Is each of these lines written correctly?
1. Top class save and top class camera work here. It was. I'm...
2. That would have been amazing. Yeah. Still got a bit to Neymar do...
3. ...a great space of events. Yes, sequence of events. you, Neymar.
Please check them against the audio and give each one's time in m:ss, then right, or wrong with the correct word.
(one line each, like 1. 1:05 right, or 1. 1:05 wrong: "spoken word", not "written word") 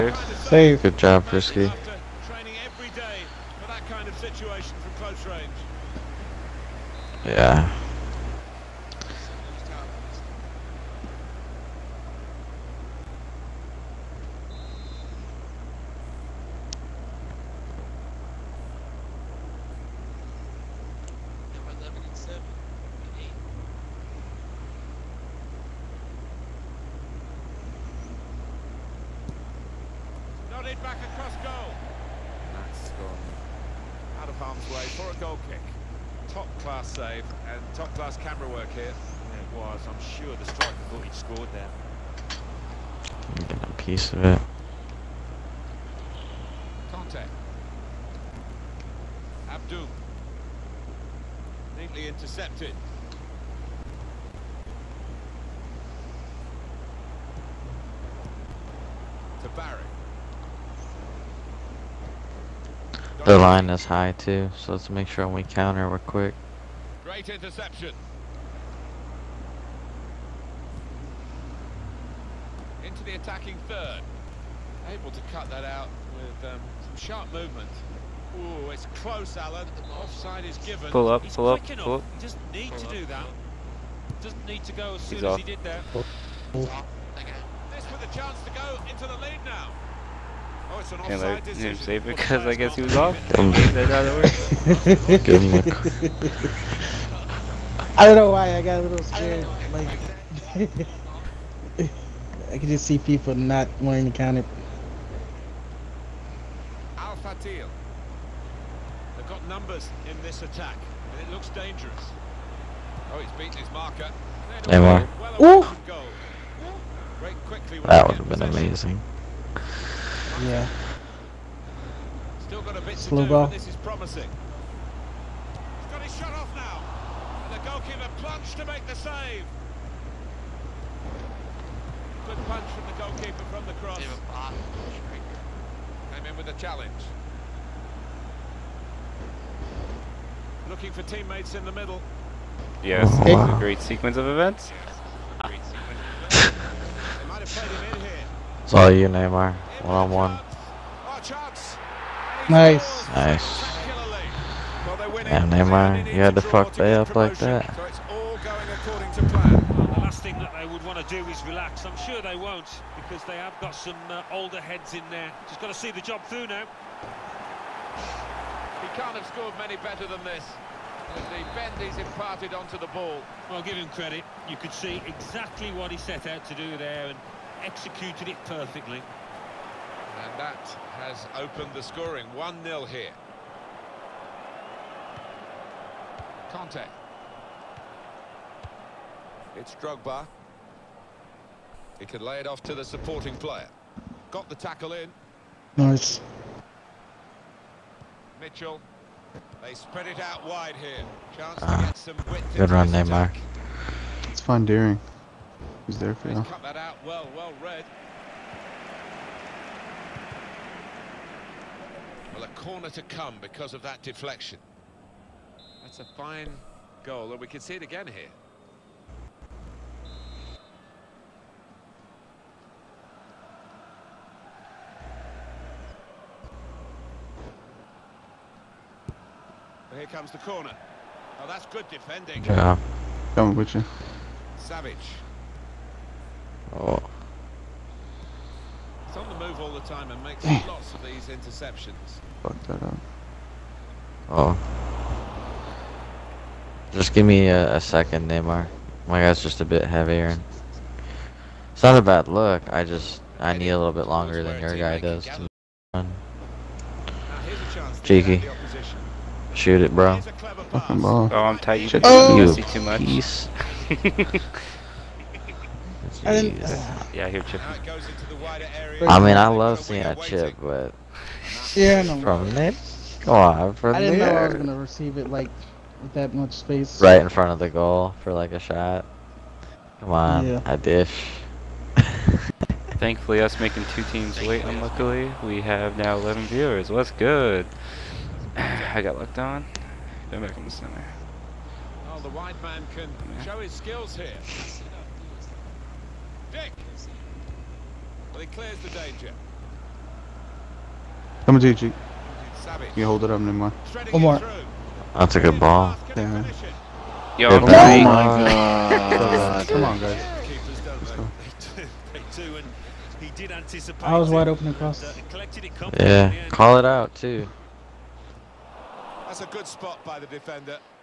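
1. 0:36 right
2. 1:57 wrong: "Slow", not "Neymar"
3. 2:23 wrong: "sequence", not "space".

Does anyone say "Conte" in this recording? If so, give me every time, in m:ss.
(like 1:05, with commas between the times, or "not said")
0:46, 3:06.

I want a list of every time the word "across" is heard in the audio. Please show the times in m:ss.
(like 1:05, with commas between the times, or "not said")
0:31, 5:14.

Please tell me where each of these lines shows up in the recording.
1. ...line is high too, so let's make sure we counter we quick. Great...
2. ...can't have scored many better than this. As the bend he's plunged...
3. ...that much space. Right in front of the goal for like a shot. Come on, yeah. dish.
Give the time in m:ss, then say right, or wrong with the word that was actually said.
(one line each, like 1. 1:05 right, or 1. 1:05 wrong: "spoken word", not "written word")
1. 1:03 right
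2. 2:48 wrong: "imparted", not "plunged"
3. 4:36 right.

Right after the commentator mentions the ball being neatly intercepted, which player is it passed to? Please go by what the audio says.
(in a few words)
Barry.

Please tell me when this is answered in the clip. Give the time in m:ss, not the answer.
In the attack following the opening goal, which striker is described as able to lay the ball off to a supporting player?
3:09.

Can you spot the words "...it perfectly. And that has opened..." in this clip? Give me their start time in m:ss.
2:58.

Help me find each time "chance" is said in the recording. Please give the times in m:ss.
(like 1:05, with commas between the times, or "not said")
1:28, 3:21.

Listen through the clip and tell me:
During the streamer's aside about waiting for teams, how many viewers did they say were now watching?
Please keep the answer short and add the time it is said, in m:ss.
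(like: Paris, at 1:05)
11, at 4:46.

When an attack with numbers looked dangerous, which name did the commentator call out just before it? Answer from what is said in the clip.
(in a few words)
Al Fatil.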